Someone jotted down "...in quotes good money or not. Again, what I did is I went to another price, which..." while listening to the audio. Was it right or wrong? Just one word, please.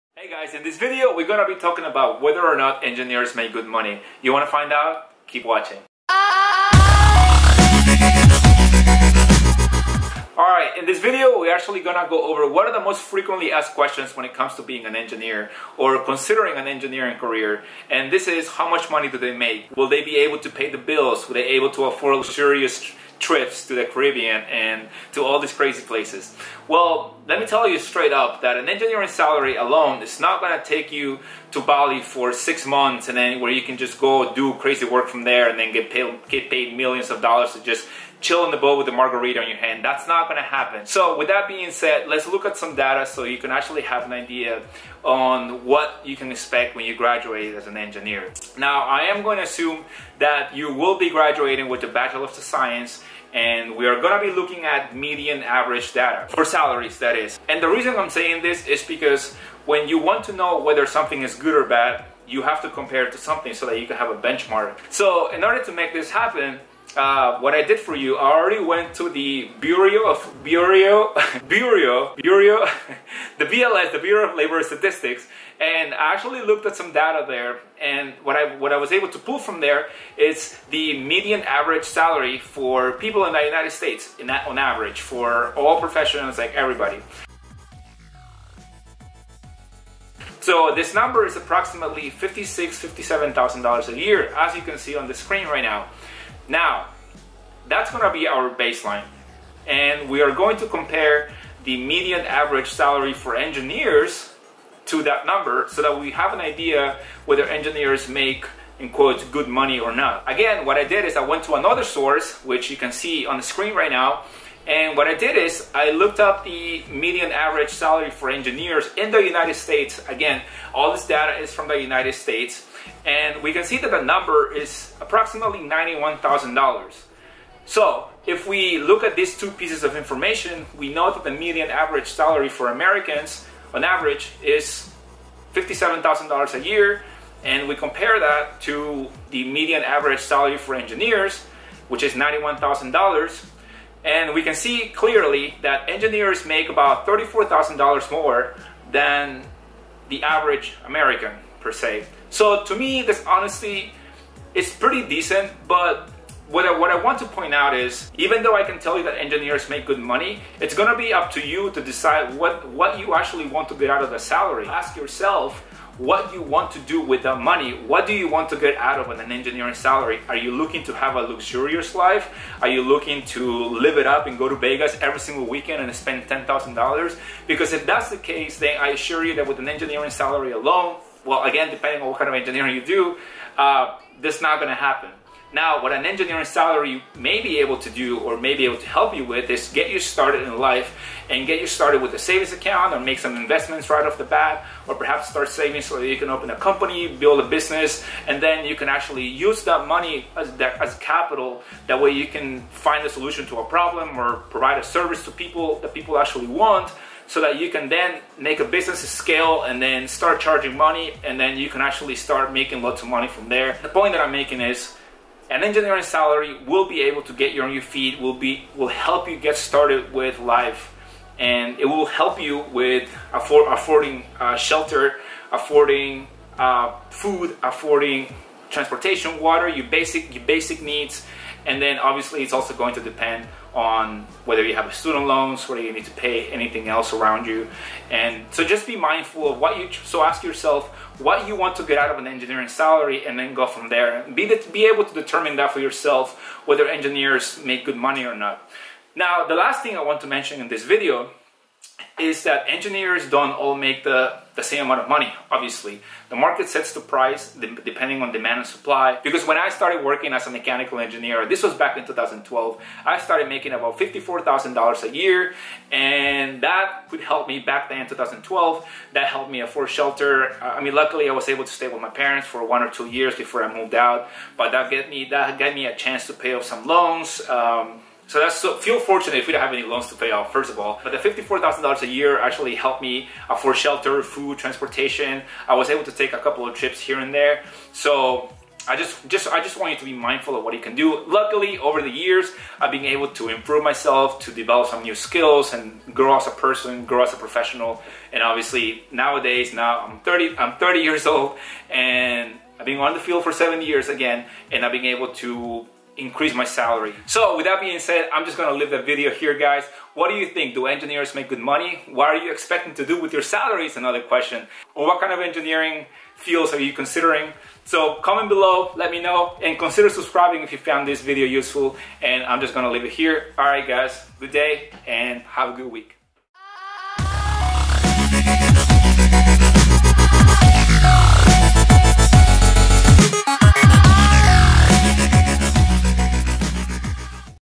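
wrong.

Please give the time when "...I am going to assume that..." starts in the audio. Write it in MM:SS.
00:48.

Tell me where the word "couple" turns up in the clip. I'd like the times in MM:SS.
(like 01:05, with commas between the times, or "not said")
04:46.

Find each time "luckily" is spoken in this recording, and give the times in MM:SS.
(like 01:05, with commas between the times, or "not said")
04:30, 04:51.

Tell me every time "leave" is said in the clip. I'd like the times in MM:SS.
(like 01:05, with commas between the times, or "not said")
05:08, 05:22.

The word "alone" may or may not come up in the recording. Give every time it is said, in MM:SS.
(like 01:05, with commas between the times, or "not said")
00:29, 03:00.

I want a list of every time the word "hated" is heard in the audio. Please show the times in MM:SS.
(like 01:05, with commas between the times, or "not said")
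not said.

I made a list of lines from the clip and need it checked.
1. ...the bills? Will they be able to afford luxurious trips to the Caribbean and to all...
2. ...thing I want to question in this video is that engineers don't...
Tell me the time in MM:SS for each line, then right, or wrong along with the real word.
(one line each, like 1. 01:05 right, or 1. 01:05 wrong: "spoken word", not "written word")
1. 00:20 right
2. 04:09 wrong: "mention", not "question".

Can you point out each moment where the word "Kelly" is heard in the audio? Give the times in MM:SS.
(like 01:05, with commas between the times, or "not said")
not said.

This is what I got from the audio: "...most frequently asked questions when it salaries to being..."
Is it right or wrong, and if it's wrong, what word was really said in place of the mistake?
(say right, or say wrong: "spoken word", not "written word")
wrong: "comes", not "salaries".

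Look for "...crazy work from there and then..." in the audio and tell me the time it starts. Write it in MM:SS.
00:34.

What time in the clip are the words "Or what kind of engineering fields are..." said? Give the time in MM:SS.
05:14.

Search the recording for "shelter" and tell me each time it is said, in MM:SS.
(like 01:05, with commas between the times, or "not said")
03:44, 04:29, 04:43.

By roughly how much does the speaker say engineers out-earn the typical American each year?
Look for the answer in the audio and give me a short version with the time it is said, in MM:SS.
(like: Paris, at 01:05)
$34,000, at 02:27.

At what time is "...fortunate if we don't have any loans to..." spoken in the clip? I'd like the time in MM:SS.
04:38.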